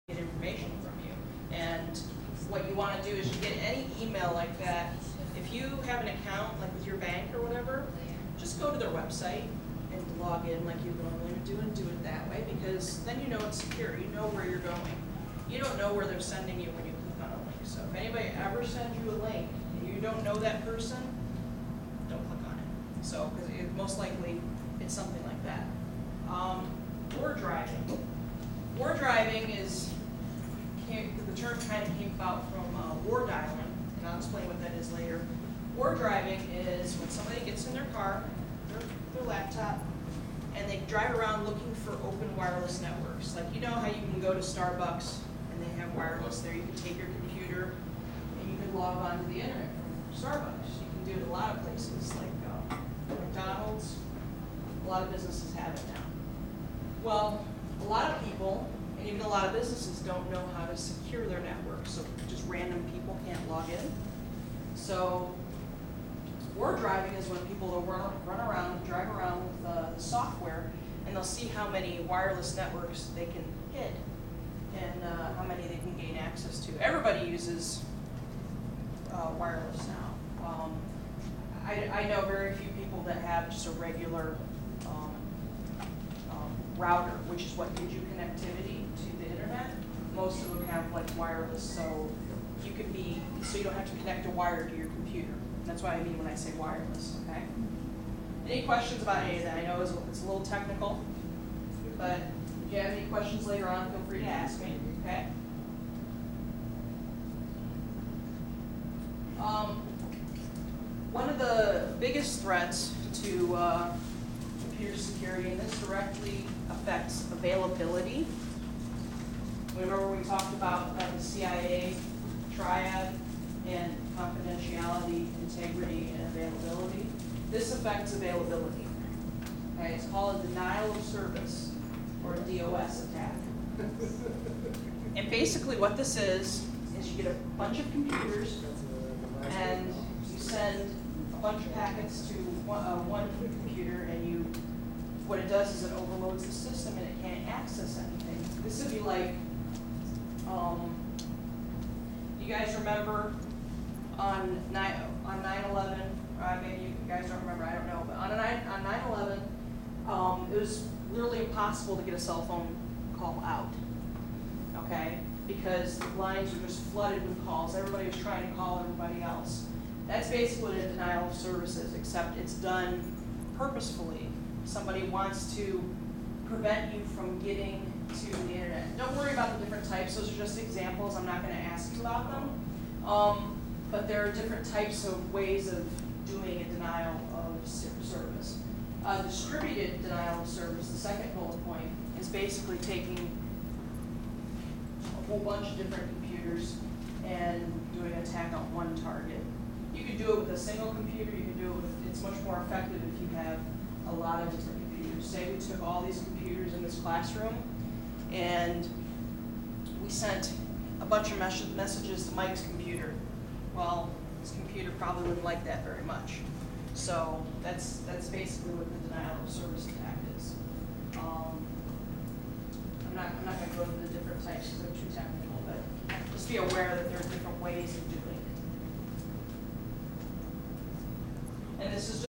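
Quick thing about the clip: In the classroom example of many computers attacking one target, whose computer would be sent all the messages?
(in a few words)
Mike's.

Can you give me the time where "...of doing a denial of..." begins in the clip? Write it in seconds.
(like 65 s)
185 s.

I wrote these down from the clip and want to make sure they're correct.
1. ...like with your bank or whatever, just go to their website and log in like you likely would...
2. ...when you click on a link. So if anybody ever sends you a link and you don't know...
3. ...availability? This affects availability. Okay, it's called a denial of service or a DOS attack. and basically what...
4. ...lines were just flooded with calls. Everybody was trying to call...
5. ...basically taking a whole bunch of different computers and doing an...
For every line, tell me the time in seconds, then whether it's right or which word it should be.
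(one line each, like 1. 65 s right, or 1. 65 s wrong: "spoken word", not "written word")
1. 6 s wrong: "normally", not "likely"
2. 16 s right
3. 126 s right
4. 166 s right
5. 192 s right.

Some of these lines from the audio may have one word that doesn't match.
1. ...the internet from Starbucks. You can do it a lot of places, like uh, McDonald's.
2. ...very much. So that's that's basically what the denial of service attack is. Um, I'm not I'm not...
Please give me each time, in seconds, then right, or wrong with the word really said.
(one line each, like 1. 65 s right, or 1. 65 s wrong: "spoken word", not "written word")
1. 49 s right
2. 215 s right.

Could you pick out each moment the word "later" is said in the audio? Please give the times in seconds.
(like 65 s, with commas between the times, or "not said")
34 s, 103 s.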